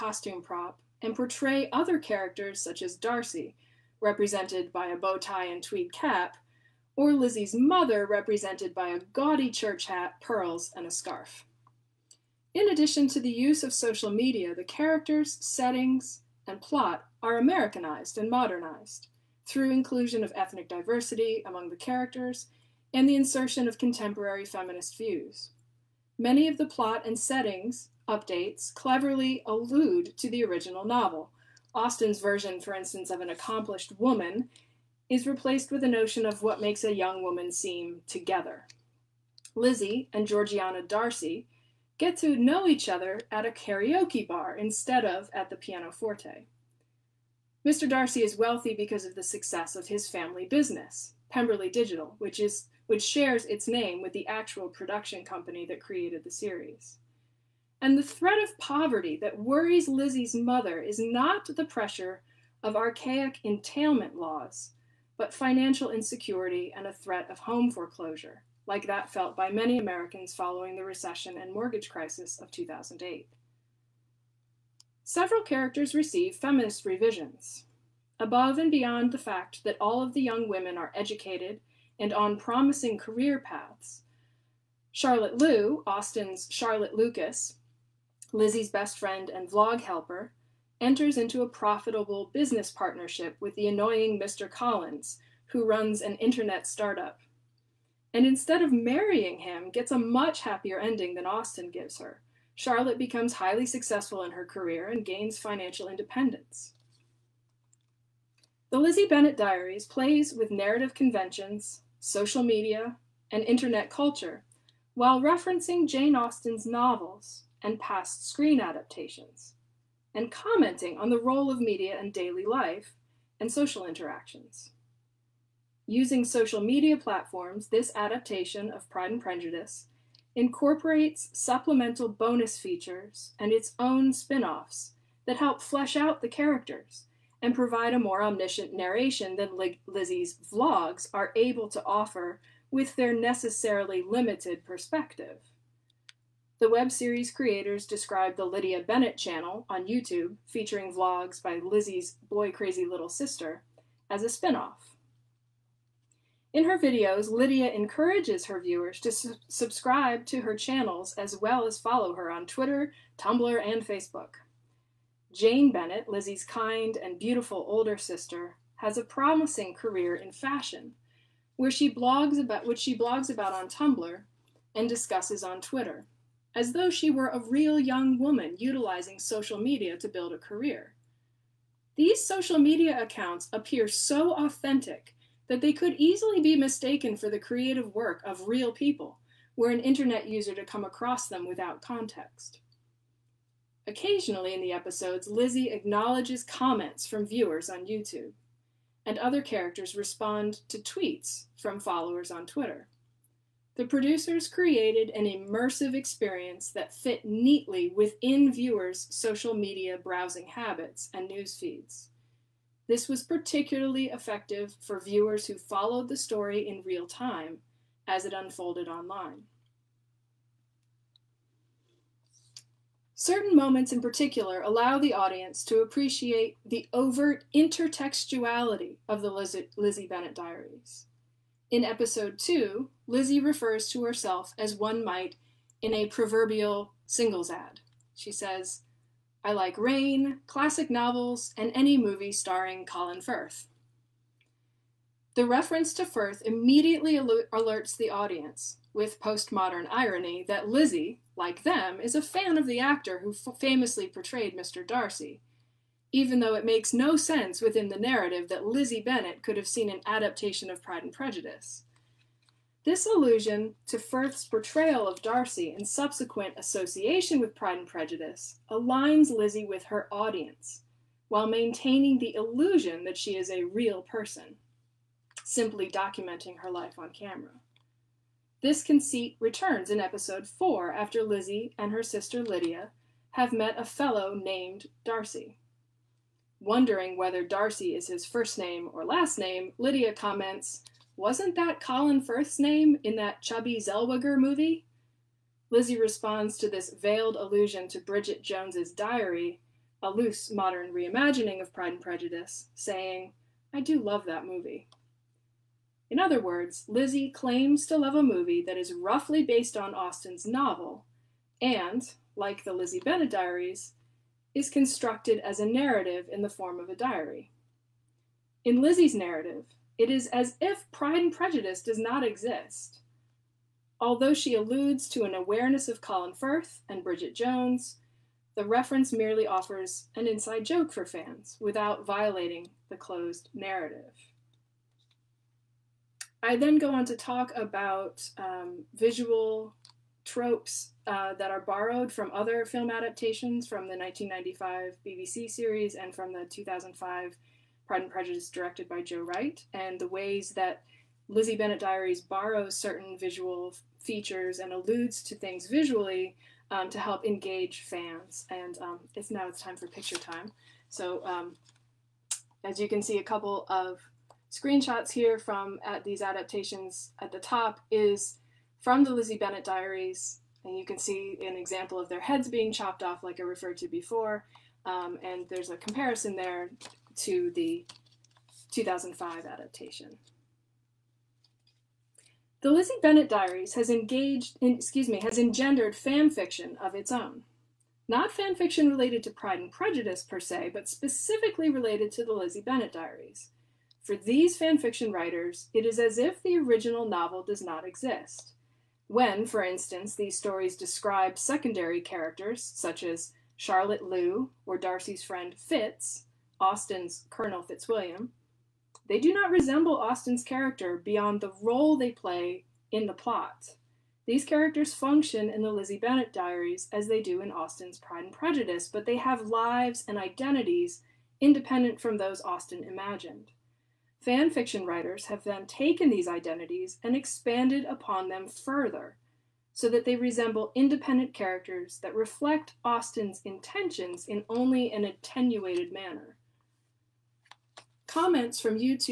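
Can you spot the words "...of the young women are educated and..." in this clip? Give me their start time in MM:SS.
01:20.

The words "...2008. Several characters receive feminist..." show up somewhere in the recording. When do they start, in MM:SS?
01:12.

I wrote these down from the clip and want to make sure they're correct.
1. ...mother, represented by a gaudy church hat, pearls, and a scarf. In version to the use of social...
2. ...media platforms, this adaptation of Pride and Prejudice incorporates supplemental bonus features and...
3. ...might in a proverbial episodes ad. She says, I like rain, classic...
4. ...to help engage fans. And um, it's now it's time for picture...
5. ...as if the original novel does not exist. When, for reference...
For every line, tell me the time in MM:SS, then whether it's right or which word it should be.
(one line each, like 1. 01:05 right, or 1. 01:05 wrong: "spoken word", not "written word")
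1. 00:07 wrong: "addition", not "version"
2. 02:06 right
3. 03:55 wrong: "singles", not "episodes"
4. 05:56 right
5. 06:35 wrong: "instance", not "reference".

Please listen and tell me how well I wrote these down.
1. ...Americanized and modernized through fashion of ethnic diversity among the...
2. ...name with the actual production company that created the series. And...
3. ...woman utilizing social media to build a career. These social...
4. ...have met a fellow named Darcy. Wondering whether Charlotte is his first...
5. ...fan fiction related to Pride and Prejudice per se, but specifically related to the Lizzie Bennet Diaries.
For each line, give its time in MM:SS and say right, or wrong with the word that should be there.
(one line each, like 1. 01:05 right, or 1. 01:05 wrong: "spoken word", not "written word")
1. 00:17 wrong: "inclusion", not "fashion"
2. 00:53 right
3. 02:58 right
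4. 04:43 wrong: "Darcy", not "Charlotte"
5. 06:28 right.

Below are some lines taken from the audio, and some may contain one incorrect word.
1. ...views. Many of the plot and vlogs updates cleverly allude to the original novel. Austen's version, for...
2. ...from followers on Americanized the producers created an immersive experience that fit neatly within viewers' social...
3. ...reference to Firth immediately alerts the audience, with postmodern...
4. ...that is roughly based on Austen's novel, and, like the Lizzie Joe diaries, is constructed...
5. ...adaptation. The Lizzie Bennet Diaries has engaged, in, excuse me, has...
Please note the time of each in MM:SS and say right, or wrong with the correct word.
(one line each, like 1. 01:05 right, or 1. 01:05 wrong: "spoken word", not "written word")
1. 00:24 wrong: "settings", not "vlogs"
2. 03:21 wrong: "Twitter", not "Americanized"
3. 04:05 right
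4. 05:08 wrong: "Bennet", not "Joe"
5. 06:19 right.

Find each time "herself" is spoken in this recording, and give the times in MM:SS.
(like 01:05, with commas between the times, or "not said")
03:54.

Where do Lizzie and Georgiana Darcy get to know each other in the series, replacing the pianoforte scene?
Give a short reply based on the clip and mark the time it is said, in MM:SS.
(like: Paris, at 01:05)
A karaoke bar, at 00:43.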